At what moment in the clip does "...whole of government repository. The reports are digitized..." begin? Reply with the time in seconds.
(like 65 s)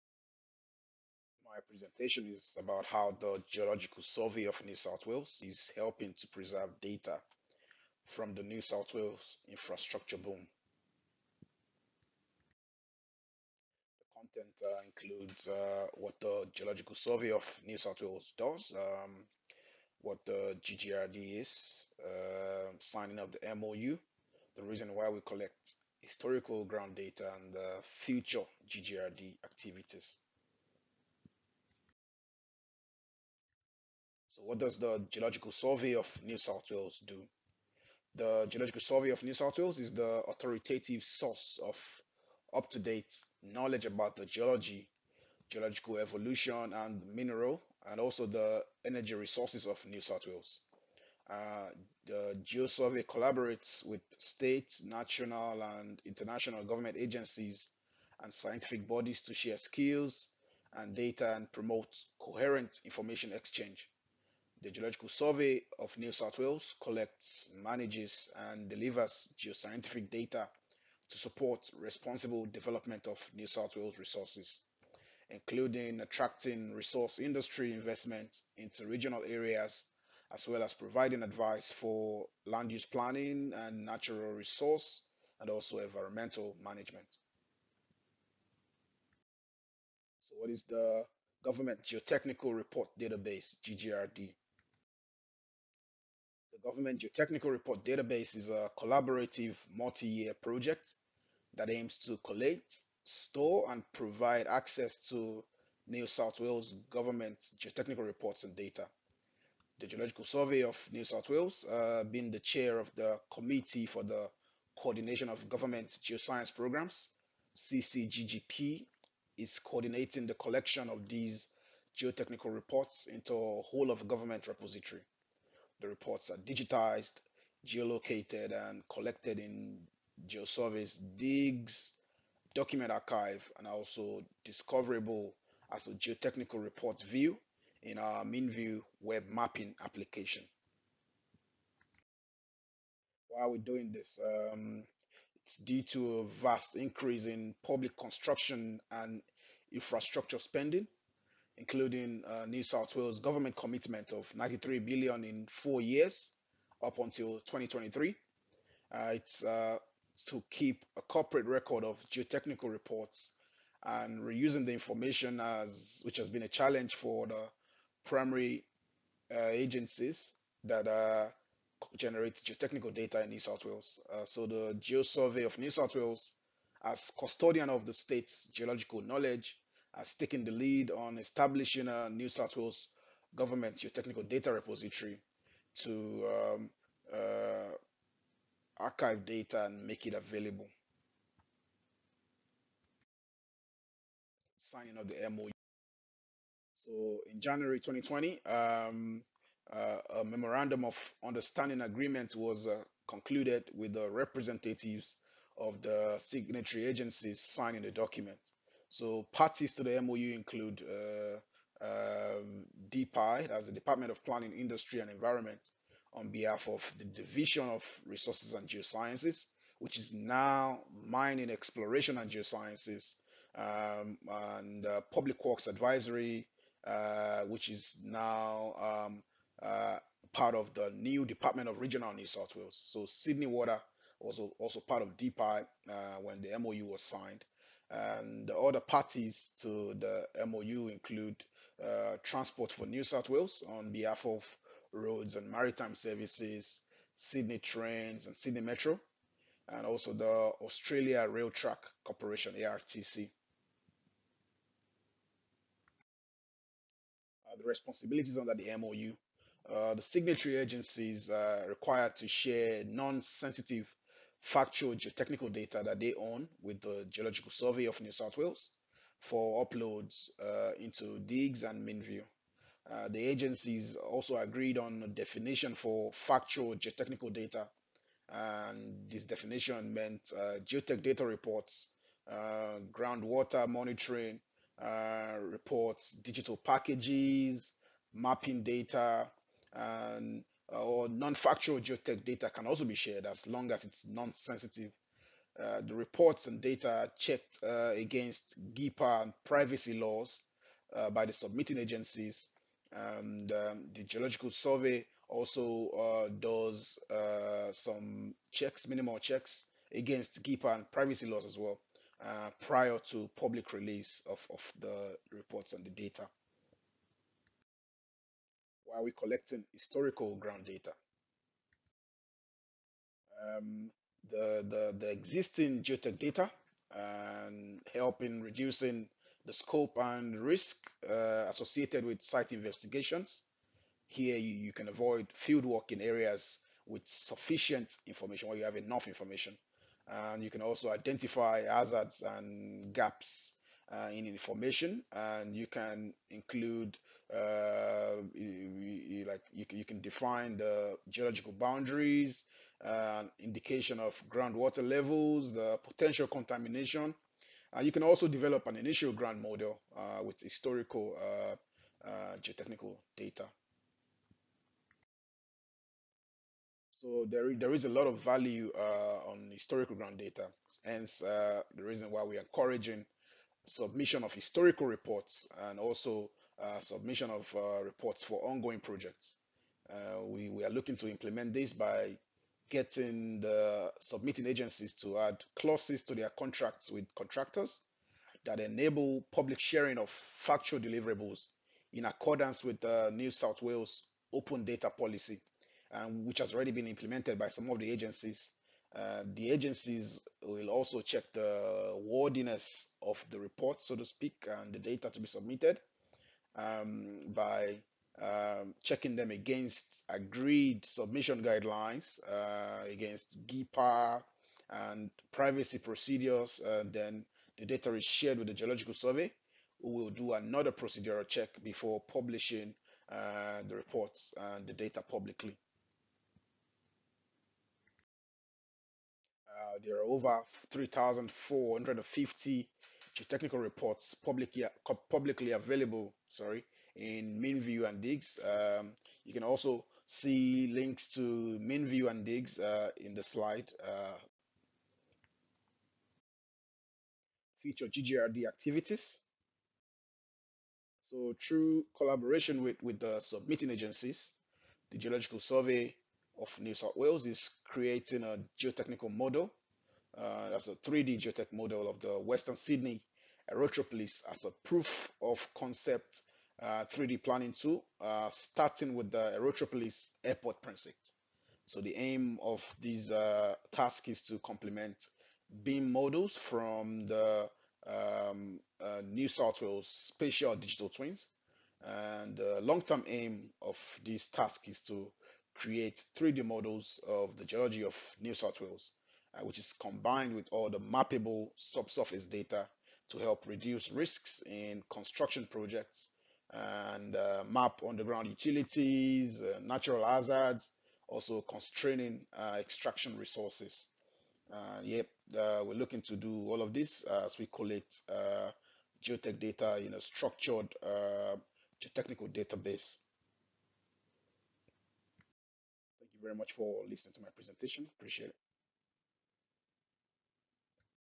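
123 s.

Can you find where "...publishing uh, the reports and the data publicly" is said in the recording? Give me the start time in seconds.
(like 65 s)
422 s.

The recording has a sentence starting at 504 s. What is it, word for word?
Uh, yep, we're looking to do all of this as we collect geotech data in a structured geotechnical database.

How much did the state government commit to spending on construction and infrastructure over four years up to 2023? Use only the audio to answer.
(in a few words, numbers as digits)
93 billion.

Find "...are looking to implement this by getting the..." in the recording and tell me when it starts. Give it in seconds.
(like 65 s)
380 s.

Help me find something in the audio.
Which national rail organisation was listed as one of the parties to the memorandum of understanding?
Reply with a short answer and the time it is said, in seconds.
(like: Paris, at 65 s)
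Australia Rail Track Corporation, at 250 s.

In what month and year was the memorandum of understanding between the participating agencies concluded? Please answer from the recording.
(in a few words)
January 2020.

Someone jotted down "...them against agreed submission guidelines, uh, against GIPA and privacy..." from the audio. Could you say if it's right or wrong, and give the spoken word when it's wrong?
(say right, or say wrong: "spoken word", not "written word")
right.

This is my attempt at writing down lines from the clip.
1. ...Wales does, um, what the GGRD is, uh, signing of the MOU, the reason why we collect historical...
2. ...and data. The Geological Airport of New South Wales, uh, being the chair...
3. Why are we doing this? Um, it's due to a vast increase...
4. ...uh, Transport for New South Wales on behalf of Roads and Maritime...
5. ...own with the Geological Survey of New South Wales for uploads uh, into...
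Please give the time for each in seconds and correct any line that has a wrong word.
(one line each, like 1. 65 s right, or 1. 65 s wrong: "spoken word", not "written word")
1. 18 s right
2. 108 s wrong: "Survey", not "Airport"
3. 143 s right
4. 241 s right
5. 266 s right.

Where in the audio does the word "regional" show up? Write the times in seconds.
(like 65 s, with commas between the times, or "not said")
78 s, 231 s.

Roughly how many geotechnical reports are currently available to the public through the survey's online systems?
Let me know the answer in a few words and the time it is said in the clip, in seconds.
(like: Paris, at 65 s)
3,450, at 430 s.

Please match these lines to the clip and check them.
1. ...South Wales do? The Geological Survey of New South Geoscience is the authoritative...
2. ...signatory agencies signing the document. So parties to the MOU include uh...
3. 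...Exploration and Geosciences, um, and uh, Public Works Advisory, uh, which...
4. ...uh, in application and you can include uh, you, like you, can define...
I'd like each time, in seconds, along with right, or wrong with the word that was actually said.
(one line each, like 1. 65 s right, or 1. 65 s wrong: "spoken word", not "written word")
1. 36 s wrong: "Wales", not "Geoscience"
2. 206 s right
3. 221 s right
4. 343 s wrong: "information", not "application".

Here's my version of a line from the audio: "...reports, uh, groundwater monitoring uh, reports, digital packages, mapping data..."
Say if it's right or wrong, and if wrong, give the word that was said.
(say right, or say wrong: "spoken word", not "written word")
right.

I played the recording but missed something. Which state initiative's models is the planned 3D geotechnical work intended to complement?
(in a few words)
New South Wales Spatial Digital Twins.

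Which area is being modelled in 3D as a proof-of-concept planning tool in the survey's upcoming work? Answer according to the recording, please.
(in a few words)
Western Sydney Aerotropolis.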